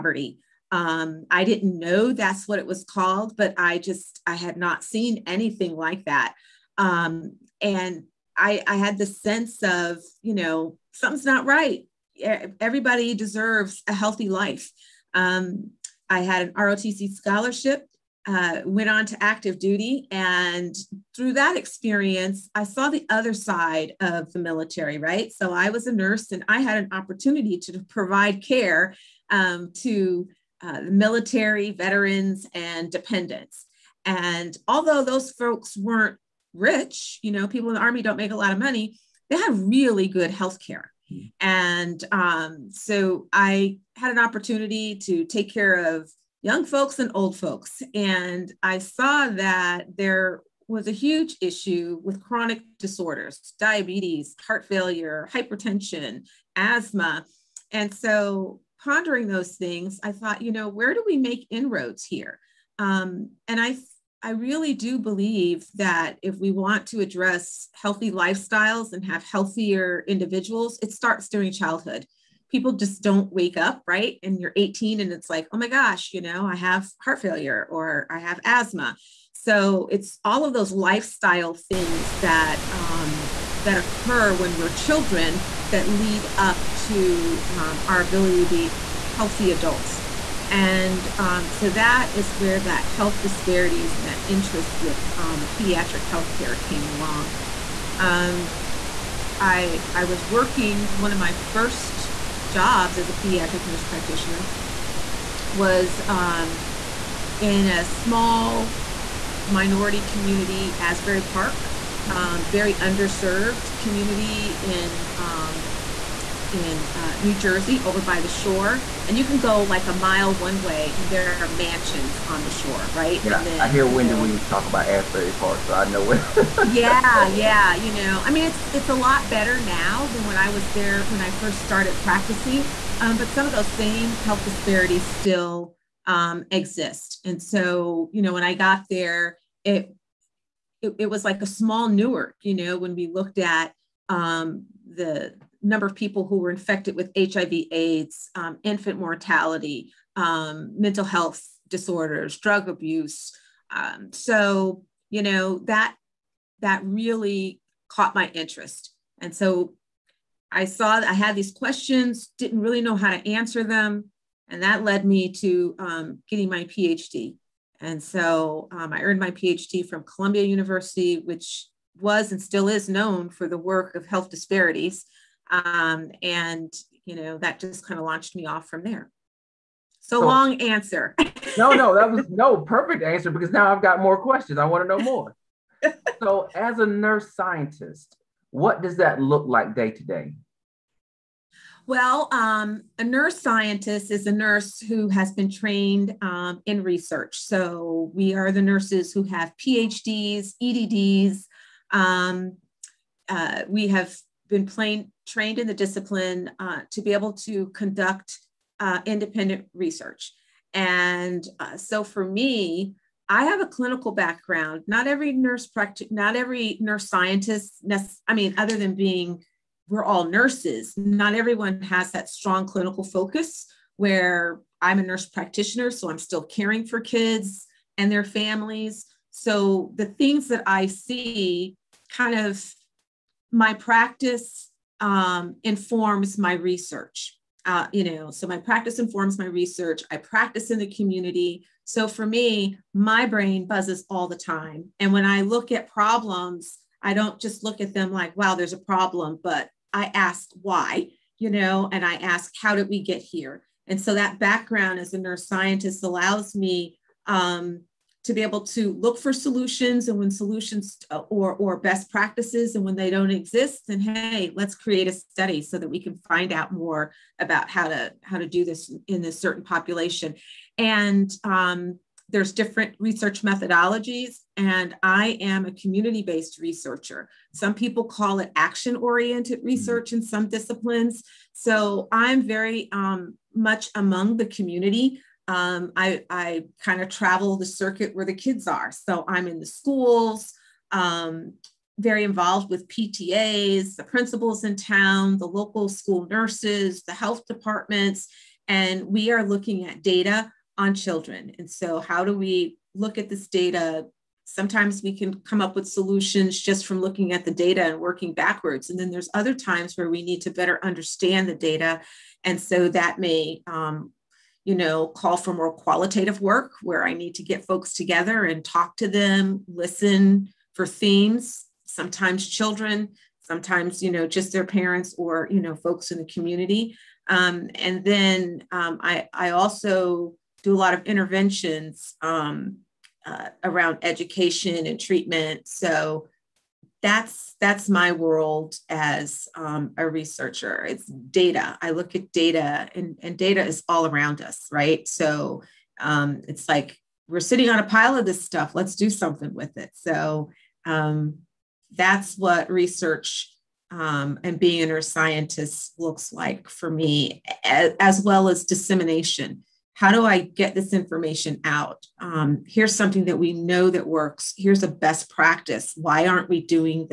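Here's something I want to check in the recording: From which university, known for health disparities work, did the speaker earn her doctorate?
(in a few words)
Columbia University.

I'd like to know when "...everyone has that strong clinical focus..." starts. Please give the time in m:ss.
3:41.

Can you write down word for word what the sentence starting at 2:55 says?
Um, and, you know, that just kind of launched me off from there.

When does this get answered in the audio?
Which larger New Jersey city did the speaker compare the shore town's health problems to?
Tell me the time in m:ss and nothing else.
2:21.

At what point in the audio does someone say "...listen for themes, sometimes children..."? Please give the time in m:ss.
5:19.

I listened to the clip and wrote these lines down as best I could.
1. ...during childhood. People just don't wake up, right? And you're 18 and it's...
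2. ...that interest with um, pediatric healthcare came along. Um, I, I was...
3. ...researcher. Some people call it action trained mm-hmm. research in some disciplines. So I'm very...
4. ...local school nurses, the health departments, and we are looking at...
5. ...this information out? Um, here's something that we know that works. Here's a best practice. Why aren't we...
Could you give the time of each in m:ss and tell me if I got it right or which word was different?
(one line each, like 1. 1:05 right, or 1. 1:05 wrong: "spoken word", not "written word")
1. 1:11 right
2. 1:34 right
3. 4:36 wrong: "oriented", not "trained"
4. 4:55 right
5. 6:00 right.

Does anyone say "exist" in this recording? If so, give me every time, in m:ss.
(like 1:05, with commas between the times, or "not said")
2:16, 4:23.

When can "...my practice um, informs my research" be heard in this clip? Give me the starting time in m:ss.
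3:53.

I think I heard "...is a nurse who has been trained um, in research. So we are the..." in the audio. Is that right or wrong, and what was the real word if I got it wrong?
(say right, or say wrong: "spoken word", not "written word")
right.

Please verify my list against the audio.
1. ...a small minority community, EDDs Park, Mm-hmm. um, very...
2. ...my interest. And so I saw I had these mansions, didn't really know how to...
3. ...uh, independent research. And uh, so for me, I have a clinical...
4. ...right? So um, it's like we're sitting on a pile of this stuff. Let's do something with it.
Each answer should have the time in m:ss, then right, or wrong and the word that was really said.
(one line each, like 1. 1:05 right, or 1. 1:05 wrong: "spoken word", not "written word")
1. 1:47 wrong: "Asbury", not "EDDs"
2. 2:38 wrong: "questions", not "mansions"
3. 3:28 right
4. 5:44 right.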